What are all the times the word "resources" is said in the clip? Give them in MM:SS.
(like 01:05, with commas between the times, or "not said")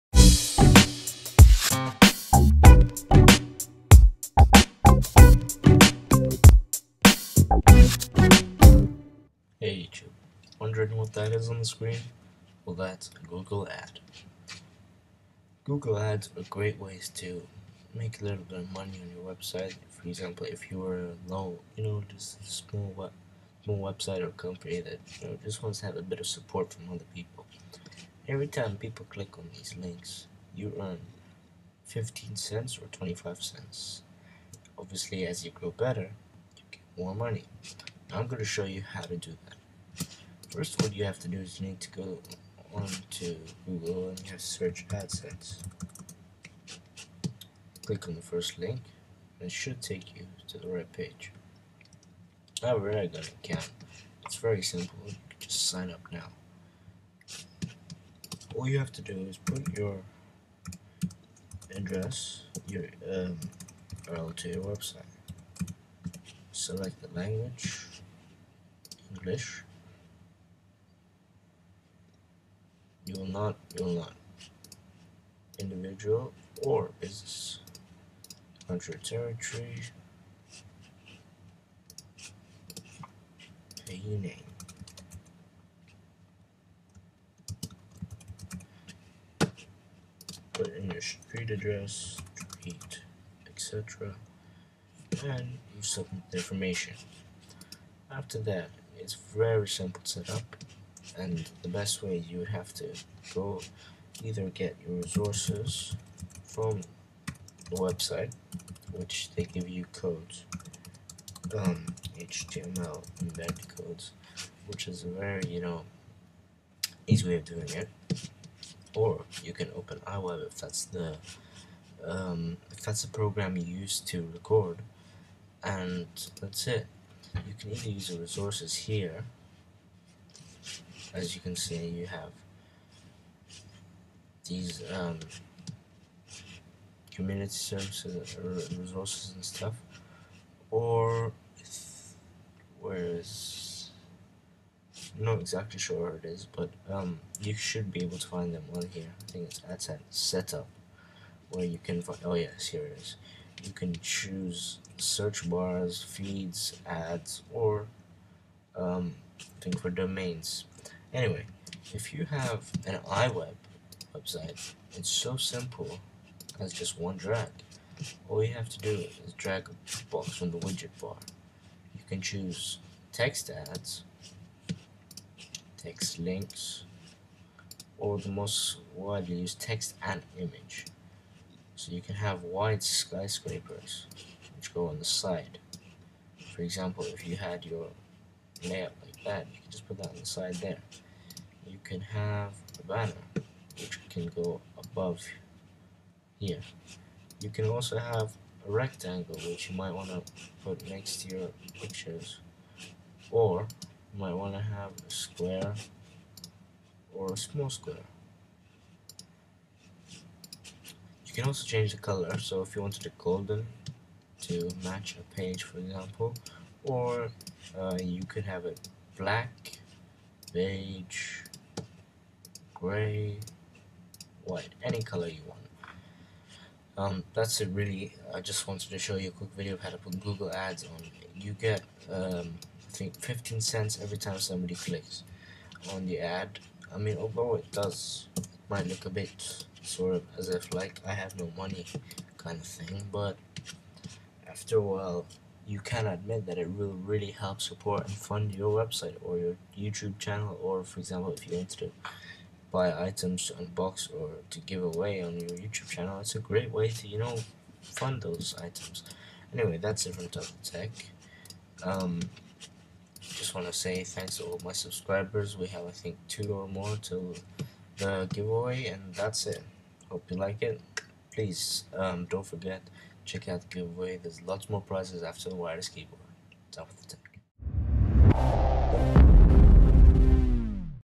01:44, 02:08, 02:18.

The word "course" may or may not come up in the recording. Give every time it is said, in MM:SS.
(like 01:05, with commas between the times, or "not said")
not said.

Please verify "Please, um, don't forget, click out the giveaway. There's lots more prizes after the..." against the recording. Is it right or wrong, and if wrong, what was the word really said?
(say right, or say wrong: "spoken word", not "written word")
wrong: "check", not "click".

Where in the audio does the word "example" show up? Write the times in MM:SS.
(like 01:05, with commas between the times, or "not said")
00:20, 03:06, 03:35, 04:10.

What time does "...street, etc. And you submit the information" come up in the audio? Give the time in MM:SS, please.
01:32.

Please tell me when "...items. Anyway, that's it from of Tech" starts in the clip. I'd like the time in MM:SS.
04:18.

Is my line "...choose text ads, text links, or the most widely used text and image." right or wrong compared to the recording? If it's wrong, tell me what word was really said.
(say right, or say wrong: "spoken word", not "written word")
right.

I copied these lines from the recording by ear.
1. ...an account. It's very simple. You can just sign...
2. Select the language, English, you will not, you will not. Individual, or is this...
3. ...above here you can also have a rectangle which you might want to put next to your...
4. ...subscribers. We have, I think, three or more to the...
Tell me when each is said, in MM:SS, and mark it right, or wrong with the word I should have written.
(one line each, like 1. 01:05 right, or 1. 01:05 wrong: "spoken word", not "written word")
1. 00:53 right
2. 01:06 right
3. 03:14 right
4. 04:24 wrong: "two", not "three".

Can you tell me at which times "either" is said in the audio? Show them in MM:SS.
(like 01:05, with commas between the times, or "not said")
01:44, 02:07.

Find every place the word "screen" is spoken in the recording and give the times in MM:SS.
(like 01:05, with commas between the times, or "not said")
00:11.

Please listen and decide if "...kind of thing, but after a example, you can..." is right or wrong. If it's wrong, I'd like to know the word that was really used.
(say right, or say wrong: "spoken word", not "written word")
wrong: "while", not "example".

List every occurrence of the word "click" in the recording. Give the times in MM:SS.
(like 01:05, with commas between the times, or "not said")
00:29, 00:47, 03:54.